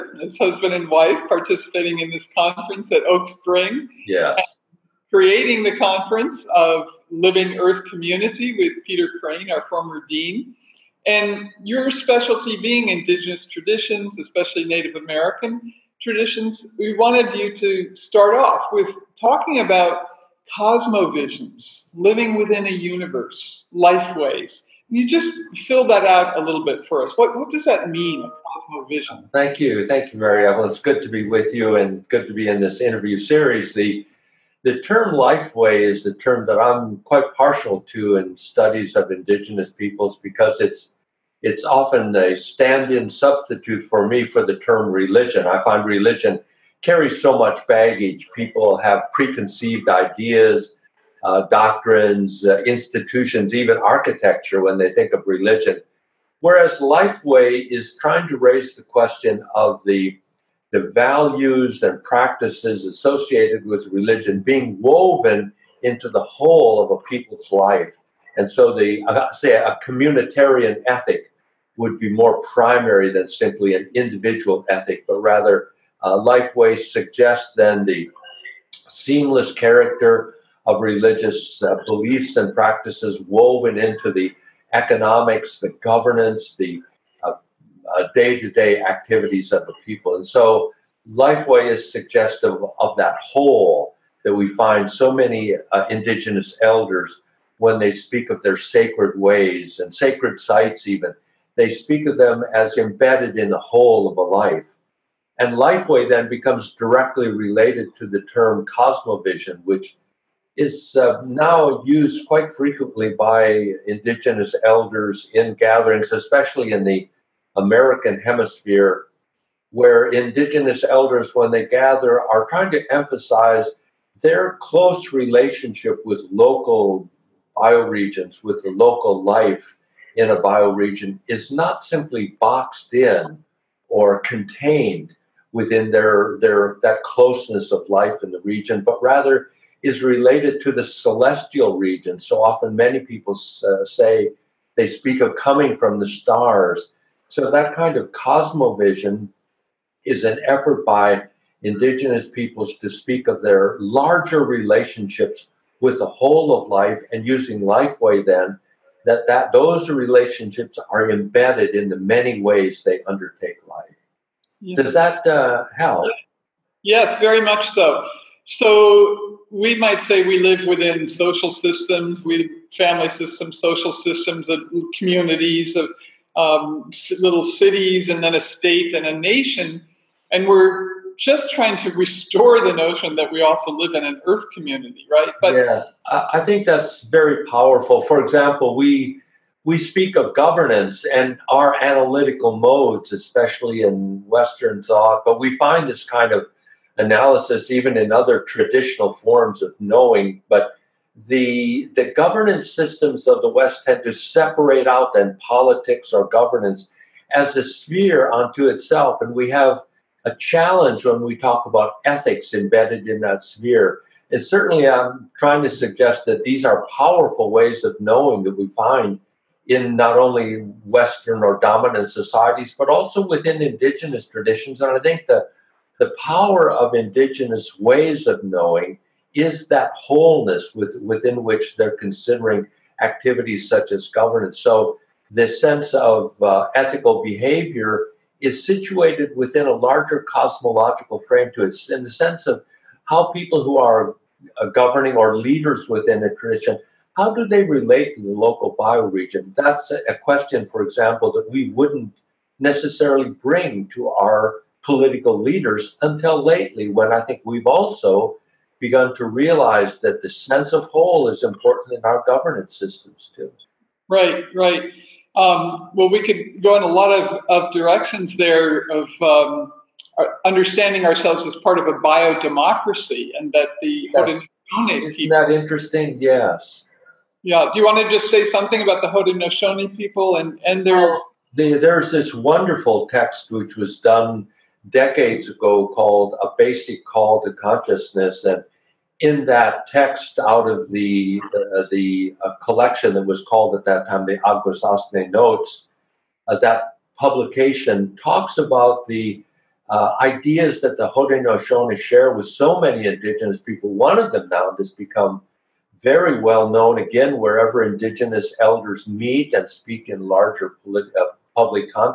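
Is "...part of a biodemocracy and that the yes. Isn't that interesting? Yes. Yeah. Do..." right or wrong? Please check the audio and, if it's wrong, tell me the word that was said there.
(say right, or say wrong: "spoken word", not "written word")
right.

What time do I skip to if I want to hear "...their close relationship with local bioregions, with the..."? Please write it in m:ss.
2:04.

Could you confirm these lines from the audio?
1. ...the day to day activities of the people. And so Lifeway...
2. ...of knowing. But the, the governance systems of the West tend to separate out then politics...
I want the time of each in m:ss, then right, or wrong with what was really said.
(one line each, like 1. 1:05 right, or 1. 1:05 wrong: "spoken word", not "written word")
1. 1:26 right
2. 3:19 right.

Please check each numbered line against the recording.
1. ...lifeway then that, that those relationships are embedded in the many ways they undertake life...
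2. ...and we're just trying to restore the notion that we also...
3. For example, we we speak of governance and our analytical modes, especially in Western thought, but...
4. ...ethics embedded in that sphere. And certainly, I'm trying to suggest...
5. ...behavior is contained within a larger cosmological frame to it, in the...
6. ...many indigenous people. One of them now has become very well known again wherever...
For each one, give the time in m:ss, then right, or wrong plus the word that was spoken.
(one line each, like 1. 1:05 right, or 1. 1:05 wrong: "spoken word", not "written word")
1. 2:37 right
2. 3:00 right
3. 3:08 right
4. 3:32 right
5. 3:57 wrong: "situated", not "contained"
6. 5:02 right.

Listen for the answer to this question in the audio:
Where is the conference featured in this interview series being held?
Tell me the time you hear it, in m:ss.
0:03.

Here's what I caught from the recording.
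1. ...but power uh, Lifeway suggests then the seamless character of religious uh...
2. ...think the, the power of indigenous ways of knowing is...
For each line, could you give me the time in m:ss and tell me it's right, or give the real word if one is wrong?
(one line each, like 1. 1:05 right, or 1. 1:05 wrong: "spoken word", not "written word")
1. 1:15 wrong: "rather", not "power"
2. 3:45 right.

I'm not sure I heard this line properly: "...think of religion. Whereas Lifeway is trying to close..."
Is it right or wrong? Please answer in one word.
wrong.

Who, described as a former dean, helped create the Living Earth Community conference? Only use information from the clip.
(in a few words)
Peter Crane.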